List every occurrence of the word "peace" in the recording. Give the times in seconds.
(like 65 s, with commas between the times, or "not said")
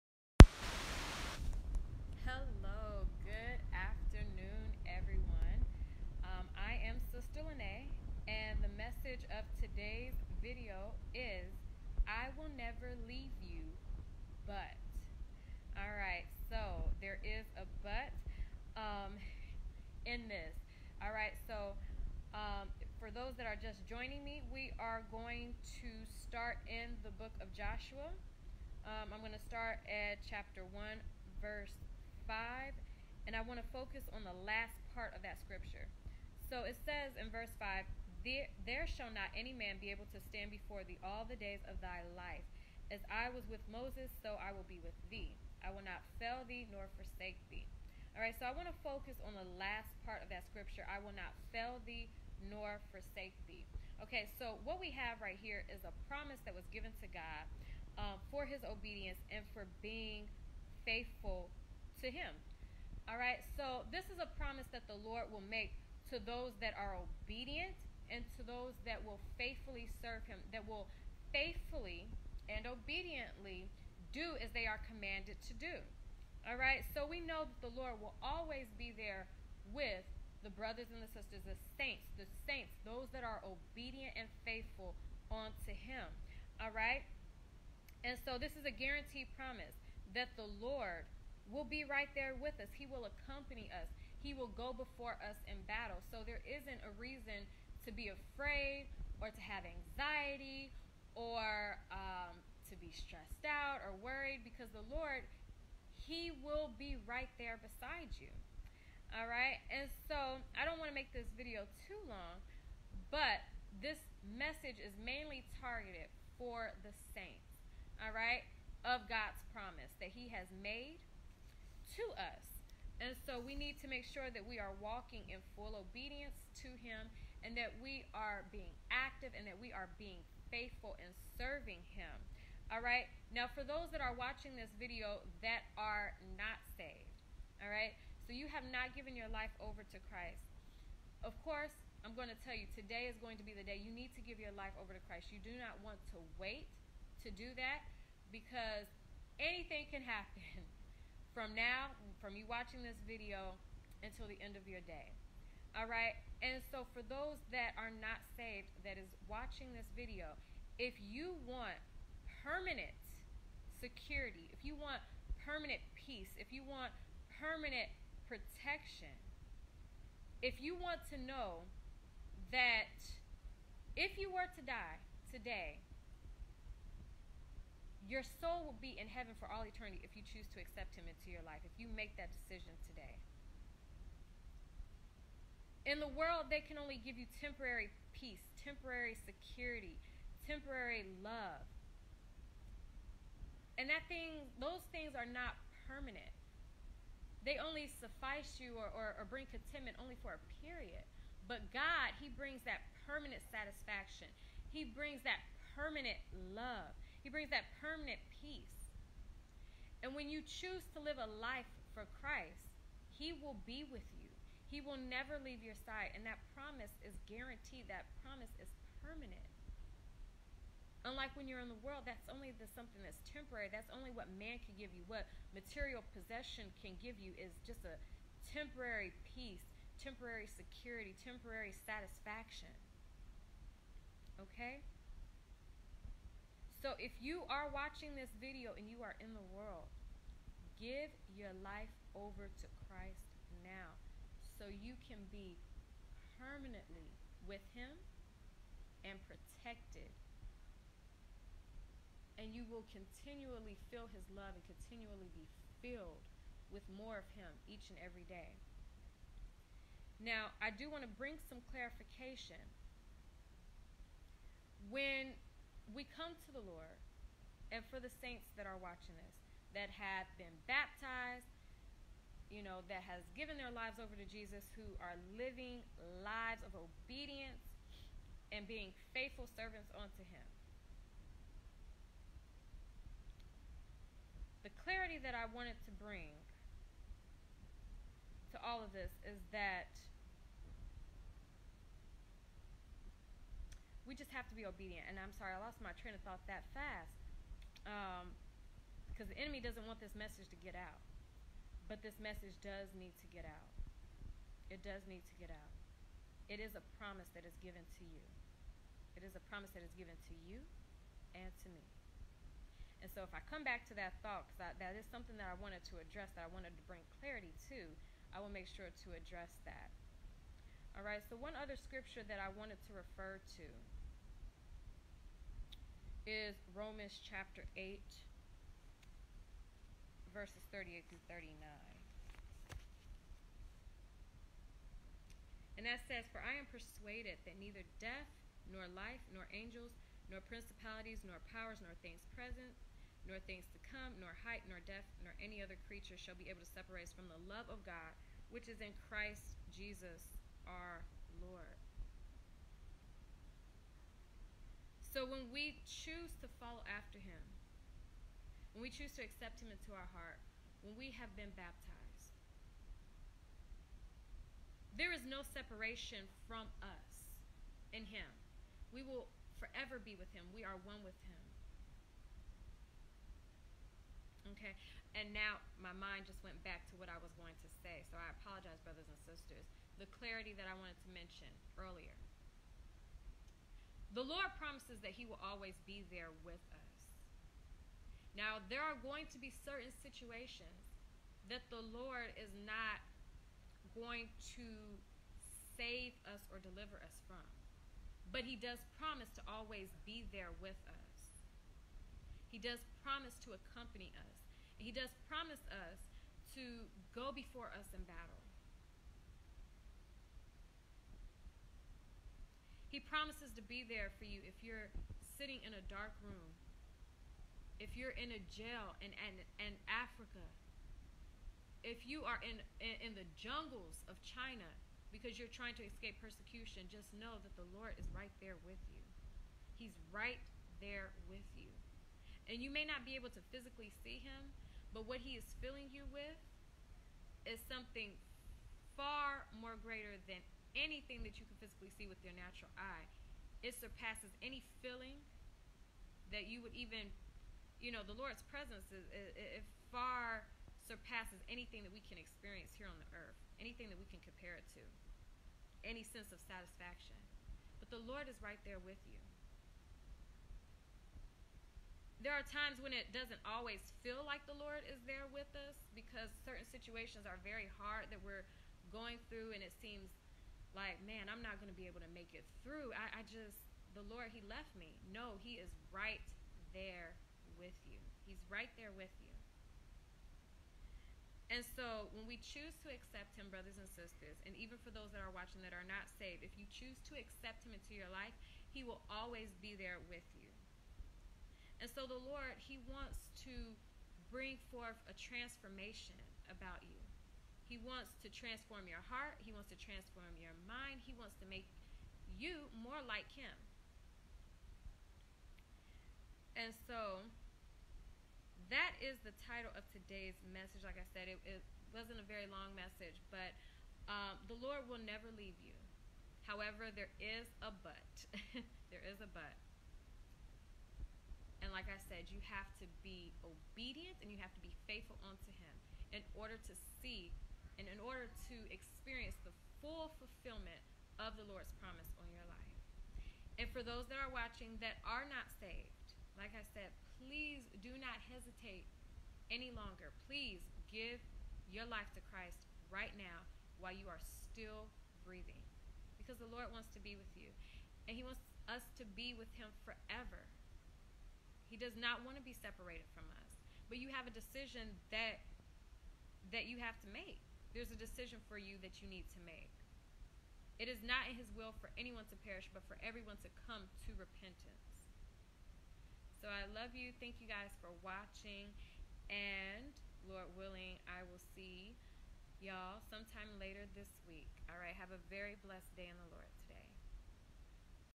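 165 s, 188 s, 208 s, 229 s.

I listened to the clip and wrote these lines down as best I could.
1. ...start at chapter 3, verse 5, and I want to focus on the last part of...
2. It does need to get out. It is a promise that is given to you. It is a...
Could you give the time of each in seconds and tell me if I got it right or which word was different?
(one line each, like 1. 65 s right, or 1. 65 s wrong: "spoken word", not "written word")
1. 29 s wrong: "1", not "3"
2. 304 s right.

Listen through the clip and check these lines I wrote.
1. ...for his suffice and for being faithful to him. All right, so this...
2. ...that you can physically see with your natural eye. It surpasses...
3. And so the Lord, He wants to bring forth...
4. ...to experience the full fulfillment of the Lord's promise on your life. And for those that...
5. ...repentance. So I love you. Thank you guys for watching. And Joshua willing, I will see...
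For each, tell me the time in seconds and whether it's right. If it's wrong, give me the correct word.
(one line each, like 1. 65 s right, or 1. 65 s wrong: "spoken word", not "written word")
1. 58 s wrong: "obedience", not "suffice"
2. 441 s right
3. 491 s right
4. 528 s right
5. 564 s wrong: "Lord", not "Joshua".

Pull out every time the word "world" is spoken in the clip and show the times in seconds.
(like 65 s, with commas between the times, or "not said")
186 s, 221 s, 239 s.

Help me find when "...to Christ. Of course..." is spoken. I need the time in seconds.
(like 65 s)
139 s.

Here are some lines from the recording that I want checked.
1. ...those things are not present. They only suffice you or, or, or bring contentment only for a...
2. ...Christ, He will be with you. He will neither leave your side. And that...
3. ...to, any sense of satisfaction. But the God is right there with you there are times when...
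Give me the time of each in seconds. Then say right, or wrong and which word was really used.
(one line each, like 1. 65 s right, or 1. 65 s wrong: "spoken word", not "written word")
1. 194 s wrong: "permanent", not "present"
2. 212 s wrong: "never", not "neither"
3. 454 s wrong: "Lord", not "God".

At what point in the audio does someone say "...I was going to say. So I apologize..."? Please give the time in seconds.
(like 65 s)
377 s.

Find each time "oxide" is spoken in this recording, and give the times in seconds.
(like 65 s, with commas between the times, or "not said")
not said.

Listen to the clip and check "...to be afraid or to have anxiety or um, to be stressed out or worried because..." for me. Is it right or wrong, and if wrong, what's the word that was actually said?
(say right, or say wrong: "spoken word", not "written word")
right.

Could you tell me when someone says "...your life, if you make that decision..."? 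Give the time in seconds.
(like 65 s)
181 s.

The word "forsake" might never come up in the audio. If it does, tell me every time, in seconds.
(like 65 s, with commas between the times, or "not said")
46 s, 52 s.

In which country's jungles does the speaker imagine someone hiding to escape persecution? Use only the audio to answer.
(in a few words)
China.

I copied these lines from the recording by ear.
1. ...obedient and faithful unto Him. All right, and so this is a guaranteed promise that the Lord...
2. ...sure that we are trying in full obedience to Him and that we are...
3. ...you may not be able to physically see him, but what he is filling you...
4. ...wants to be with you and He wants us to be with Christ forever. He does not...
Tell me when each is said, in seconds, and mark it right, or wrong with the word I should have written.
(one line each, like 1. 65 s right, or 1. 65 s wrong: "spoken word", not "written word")
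1. 83 s right
2. 124 s wrong: "walking", not "trying"
3. 432 s right
4. 546 s wrong: "Him", not "Christ".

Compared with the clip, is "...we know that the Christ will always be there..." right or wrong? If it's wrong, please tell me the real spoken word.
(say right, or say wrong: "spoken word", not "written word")
wrong: "Lord", not "Christ".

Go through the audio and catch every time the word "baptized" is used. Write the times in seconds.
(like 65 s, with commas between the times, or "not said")
270 s, 361 s.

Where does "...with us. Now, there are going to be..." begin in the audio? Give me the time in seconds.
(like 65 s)
386 s.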